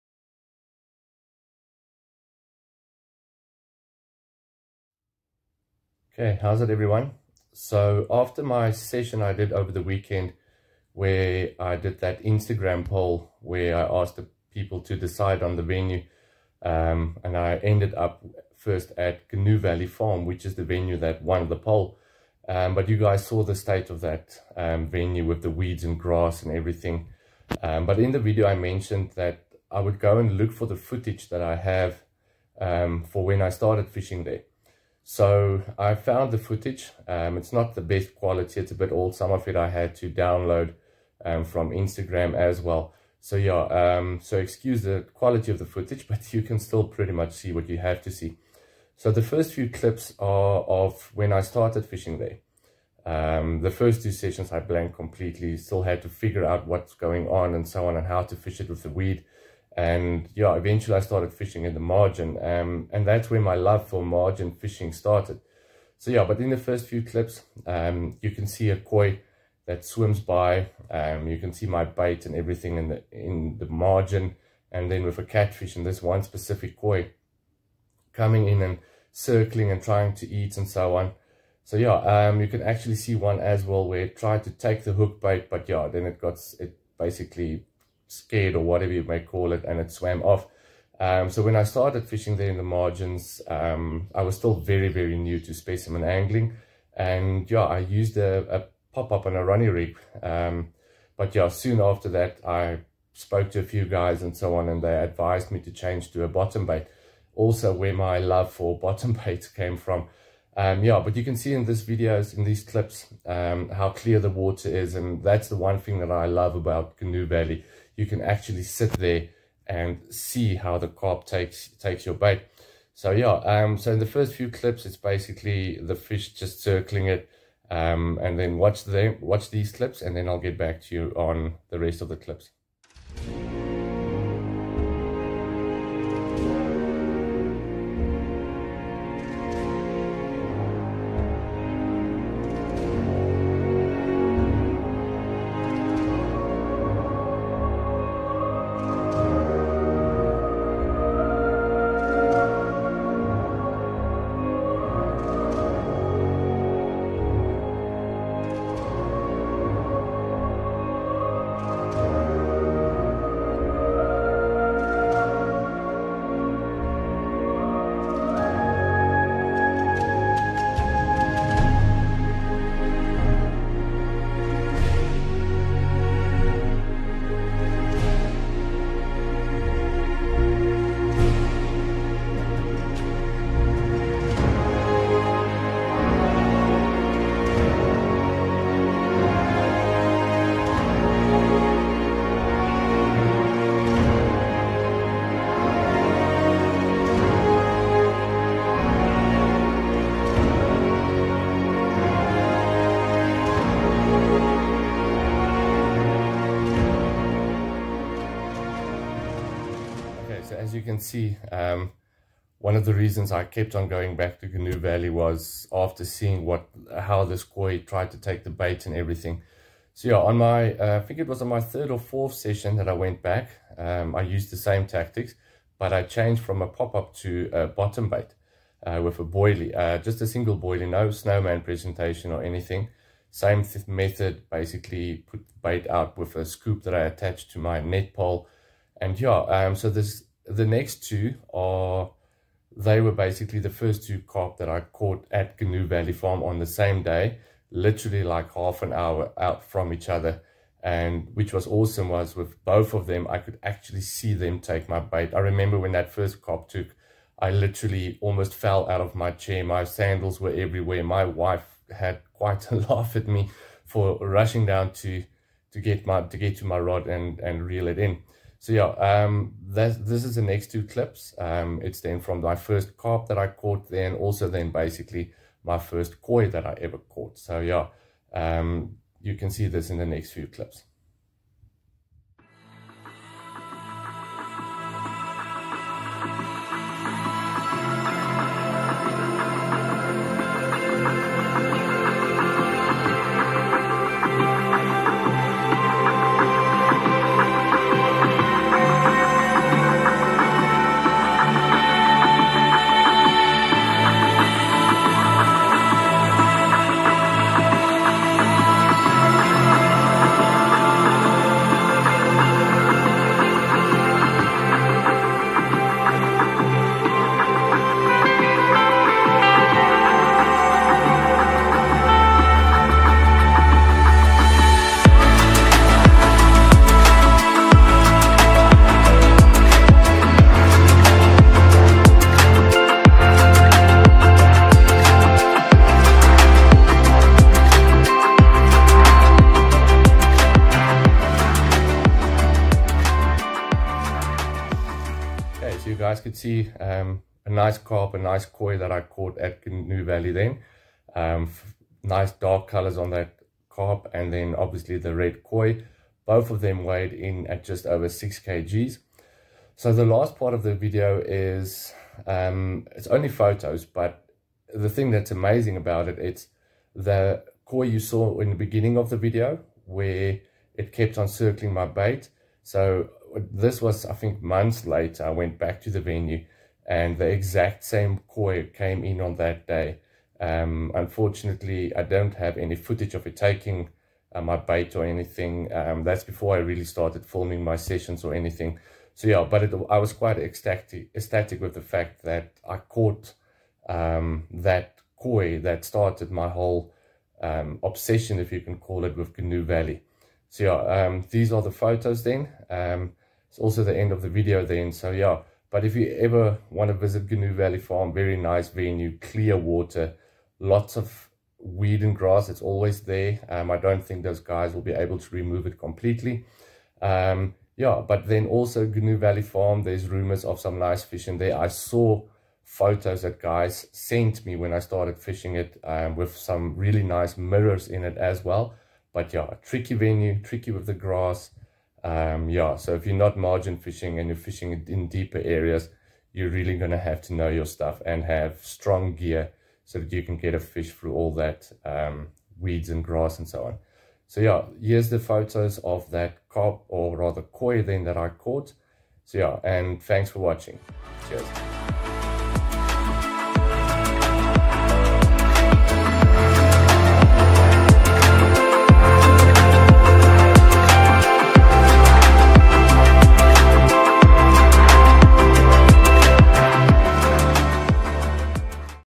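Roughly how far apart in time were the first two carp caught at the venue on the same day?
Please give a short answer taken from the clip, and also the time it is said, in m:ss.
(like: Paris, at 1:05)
Half an hour, at 4:08.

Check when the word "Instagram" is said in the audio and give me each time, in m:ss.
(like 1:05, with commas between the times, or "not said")
0:12, 0:41.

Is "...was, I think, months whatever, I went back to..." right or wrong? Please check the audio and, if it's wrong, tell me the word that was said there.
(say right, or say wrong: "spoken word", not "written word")
wrong: "later", not "whatever".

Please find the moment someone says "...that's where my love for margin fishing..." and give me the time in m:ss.
1:03.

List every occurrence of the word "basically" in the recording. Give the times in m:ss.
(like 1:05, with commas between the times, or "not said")
1:26, 2:04, 3:54, 4:03, 4:34.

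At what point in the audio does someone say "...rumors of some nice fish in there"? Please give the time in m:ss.
7:00.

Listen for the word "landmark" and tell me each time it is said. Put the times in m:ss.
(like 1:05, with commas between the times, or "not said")
not said.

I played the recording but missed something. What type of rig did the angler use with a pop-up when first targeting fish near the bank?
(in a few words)
Ronnie rig.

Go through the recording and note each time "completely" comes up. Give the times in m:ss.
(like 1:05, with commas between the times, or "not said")
0:54, 6:55.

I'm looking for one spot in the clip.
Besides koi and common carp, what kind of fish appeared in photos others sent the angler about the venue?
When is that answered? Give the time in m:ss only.
7:07.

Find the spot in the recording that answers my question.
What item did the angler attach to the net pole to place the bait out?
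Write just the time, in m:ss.
3:56.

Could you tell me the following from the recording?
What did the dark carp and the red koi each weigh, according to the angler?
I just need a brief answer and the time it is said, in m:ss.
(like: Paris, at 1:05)
Just over 6 kg, at 5:57.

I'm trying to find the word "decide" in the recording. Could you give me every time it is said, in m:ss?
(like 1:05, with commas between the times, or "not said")
0:14.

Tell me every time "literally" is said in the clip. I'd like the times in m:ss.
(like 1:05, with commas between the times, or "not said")
4:07, 4:17.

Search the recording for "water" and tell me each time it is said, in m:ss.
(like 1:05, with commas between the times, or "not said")
1:54, 6:49.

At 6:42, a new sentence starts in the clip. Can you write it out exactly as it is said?
Um, it's also the end of the video then.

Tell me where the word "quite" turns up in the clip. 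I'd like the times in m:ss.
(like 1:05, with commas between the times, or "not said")
4:22, 6:30.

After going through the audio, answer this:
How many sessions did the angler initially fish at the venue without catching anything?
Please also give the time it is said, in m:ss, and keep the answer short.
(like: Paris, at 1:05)
2, at 0:53.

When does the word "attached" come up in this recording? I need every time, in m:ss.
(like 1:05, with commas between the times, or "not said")
3:57.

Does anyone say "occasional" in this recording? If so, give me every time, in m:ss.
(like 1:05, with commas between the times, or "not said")
not said.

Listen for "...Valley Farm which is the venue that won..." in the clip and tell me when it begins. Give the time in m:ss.
0:19.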